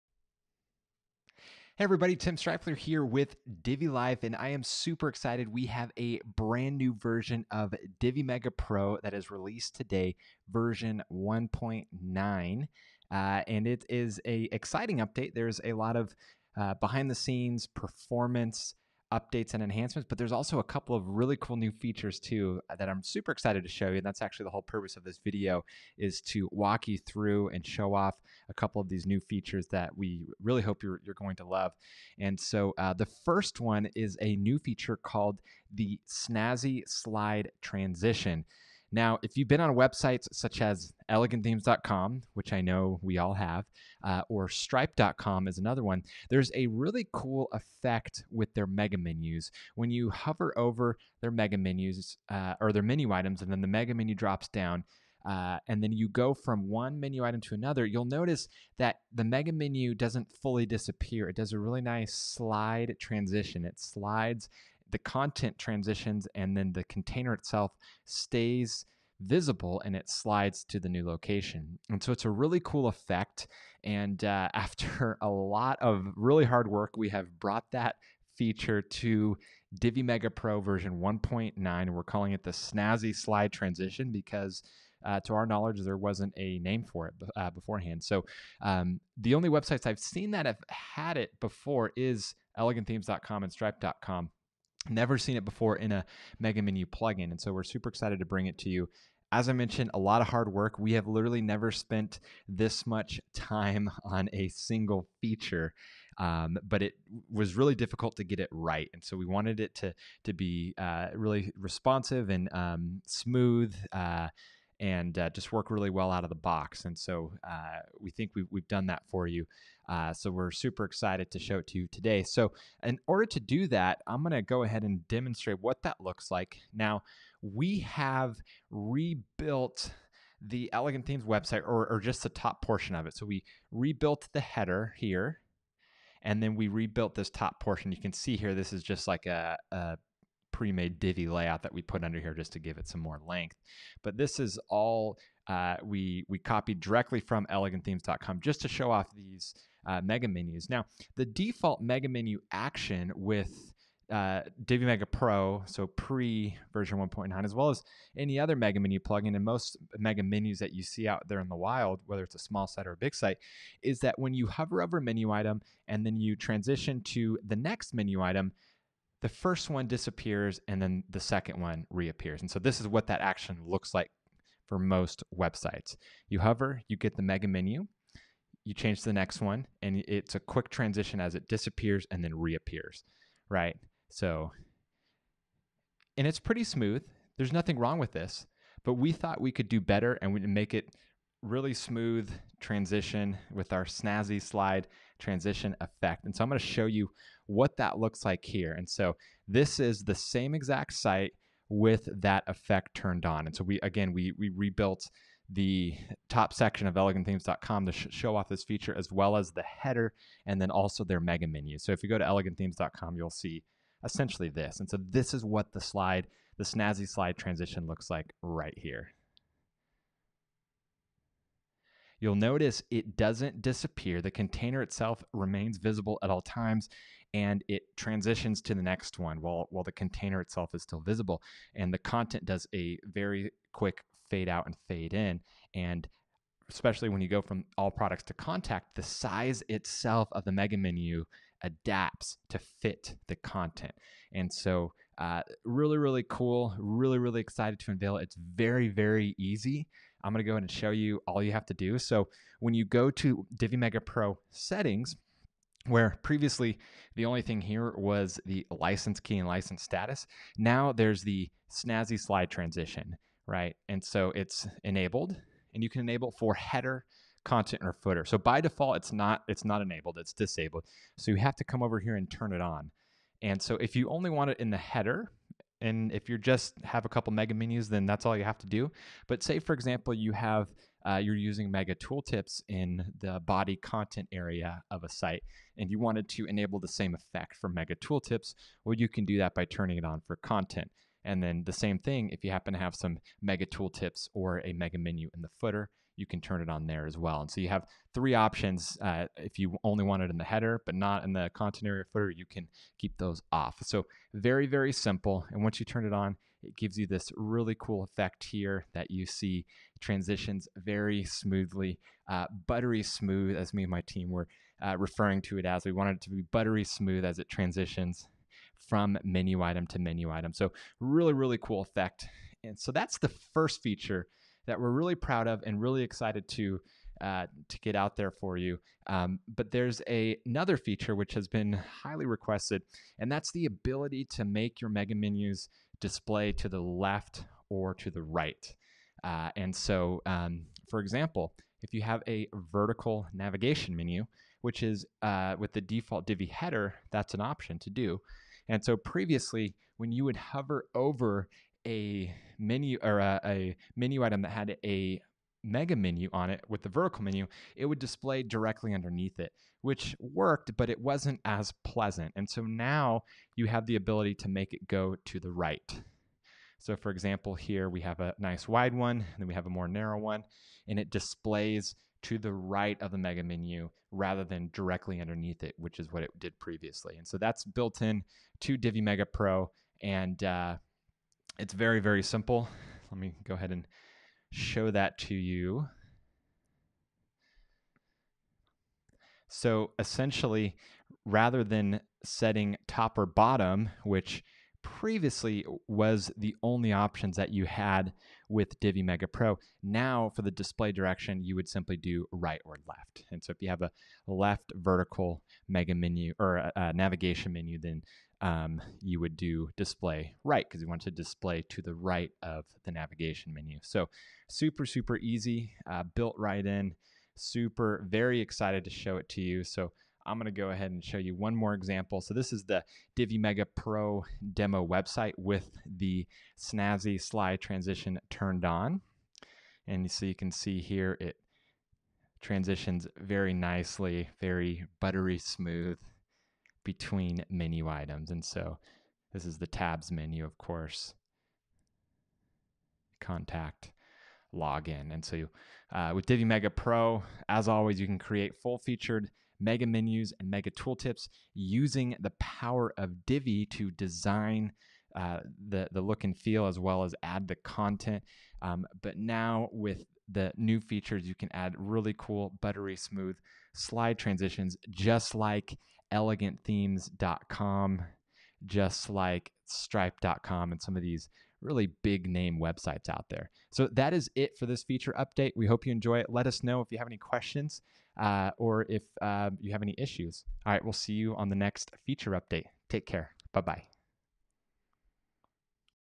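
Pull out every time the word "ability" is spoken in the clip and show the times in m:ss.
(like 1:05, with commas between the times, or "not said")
5:33, 6:03.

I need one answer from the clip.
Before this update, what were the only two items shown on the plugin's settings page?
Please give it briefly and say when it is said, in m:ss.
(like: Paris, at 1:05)
license key and license status, at 4:18.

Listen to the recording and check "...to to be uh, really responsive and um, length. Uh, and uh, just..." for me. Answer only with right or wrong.
wrong.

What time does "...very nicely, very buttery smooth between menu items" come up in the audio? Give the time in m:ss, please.
7:13.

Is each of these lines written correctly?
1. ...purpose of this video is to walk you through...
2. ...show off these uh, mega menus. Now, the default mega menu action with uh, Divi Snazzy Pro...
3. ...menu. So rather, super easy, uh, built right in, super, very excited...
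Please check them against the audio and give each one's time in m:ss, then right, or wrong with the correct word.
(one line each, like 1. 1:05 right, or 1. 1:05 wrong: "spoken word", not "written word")
1. 0:24 right
2. 2:28 wrong: "Mega", not "Snazzy"
3. 6:53 wrong: "super", not "rather".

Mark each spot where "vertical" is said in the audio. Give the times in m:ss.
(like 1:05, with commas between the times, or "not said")
5:42, 5:56, 6:44.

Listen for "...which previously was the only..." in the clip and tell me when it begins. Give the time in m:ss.
6:34.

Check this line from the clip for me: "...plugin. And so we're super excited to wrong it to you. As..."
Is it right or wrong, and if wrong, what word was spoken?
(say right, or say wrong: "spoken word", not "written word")
wrong: "bring", not "wrong".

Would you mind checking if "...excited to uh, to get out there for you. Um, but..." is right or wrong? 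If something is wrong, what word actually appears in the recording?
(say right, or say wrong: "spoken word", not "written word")
right.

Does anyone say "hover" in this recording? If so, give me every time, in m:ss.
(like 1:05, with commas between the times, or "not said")
0:50, 2:44, 2:56, 5:50.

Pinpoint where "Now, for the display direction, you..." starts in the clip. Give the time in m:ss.
6:39.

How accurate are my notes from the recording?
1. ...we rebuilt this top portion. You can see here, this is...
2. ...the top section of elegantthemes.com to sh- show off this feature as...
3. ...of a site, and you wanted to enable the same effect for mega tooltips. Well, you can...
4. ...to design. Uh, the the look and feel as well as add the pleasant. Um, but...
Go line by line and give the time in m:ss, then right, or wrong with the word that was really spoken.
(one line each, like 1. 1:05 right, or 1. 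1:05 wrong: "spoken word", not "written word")
1. 2:16 right
2. 3:25 right
3. 4:44 right
4. 7:33 wrong: "content", not "pleasant".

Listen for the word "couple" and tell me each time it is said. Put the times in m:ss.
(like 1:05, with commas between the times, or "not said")
0:20, 0:28, 4:37.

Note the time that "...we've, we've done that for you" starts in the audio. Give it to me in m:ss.
1:58.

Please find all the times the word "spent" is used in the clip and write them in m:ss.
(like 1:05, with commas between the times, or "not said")
1:41.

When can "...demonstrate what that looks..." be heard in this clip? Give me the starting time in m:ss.
2:05.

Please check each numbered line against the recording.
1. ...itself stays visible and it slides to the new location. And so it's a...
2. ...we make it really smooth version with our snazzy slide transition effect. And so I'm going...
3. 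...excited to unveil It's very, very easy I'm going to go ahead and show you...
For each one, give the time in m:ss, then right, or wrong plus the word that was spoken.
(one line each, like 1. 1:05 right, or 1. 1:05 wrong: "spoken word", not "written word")
1. 1:07 right
2. 3:10 wrong: "transition", not "version"
3. 4:07 right.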